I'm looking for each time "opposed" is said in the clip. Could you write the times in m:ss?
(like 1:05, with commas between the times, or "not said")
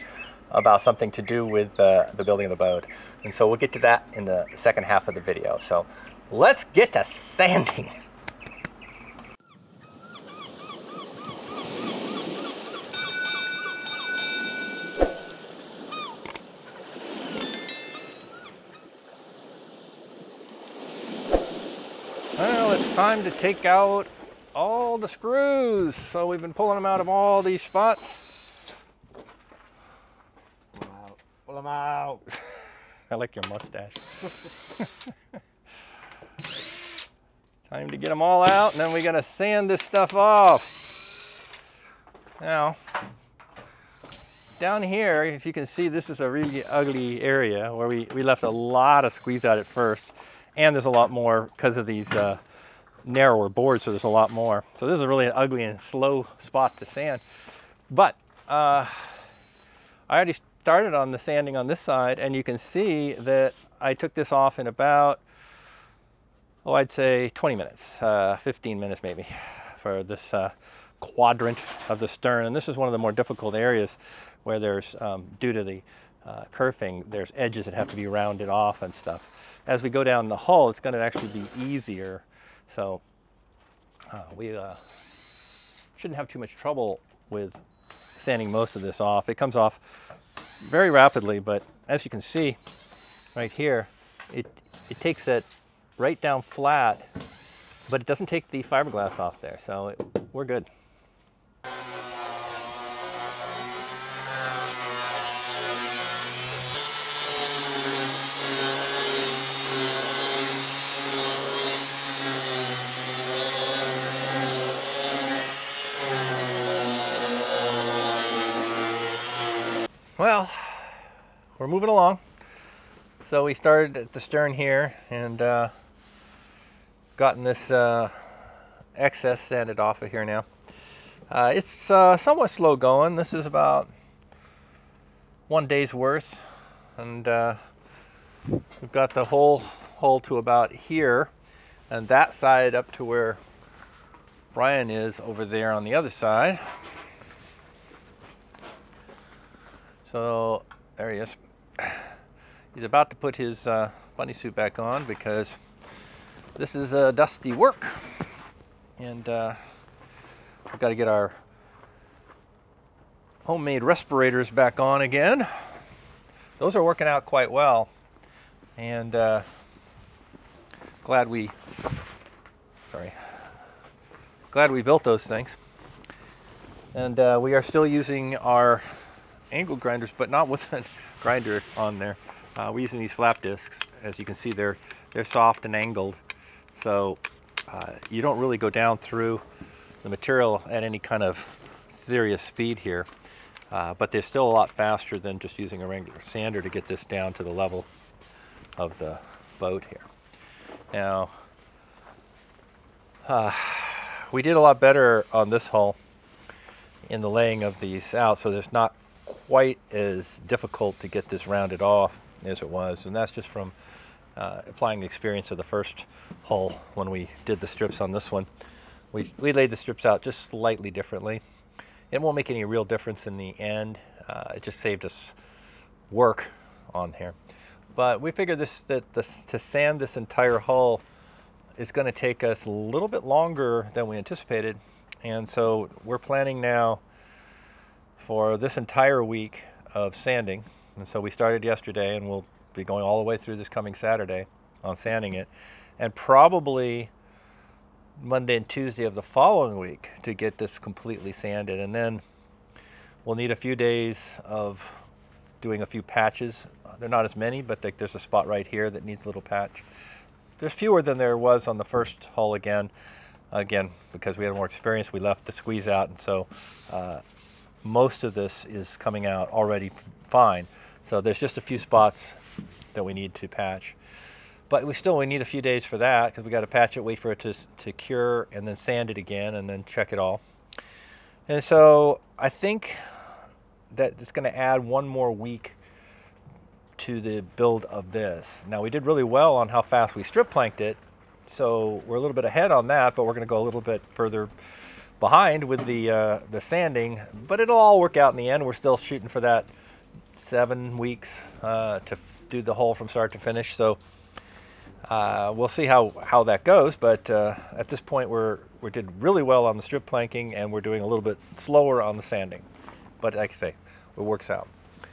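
not said.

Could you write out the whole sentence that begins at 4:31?
So there's just a few spots that we need to patch.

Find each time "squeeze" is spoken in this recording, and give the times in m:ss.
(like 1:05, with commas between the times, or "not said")
0:49, 4:25.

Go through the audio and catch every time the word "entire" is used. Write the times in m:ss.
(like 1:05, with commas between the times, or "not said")
3:50, 3:58.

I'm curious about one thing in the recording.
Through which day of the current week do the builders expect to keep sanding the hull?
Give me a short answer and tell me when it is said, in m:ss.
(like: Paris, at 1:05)
Saturday, at 4:03.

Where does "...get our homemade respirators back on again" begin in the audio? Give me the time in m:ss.
2:40.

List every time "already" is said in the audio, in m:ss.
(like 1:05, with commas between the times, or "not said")
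1:00, 4:29.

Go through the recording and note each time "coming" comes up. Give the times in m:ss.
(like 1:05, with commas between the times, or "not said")
4:03, 4:28.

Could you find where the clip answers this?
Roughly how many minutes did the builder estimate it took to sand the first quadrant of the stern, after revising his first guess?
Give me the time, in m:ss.
1:08.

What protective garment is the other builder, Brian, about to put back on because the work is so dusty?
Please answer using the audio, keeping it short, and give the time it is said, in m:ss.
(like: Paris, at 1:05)
bunny suit, at 2:34.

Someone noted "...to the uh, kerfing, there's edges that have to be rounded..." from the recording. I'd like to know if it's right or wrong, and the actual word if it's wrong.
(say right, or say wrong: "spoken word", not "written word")
right.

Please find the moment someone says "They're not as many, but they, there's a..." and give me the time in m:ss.
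4:16.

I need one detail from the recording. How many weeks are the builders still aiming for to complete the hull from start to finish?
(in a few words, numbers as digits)
7 weeks.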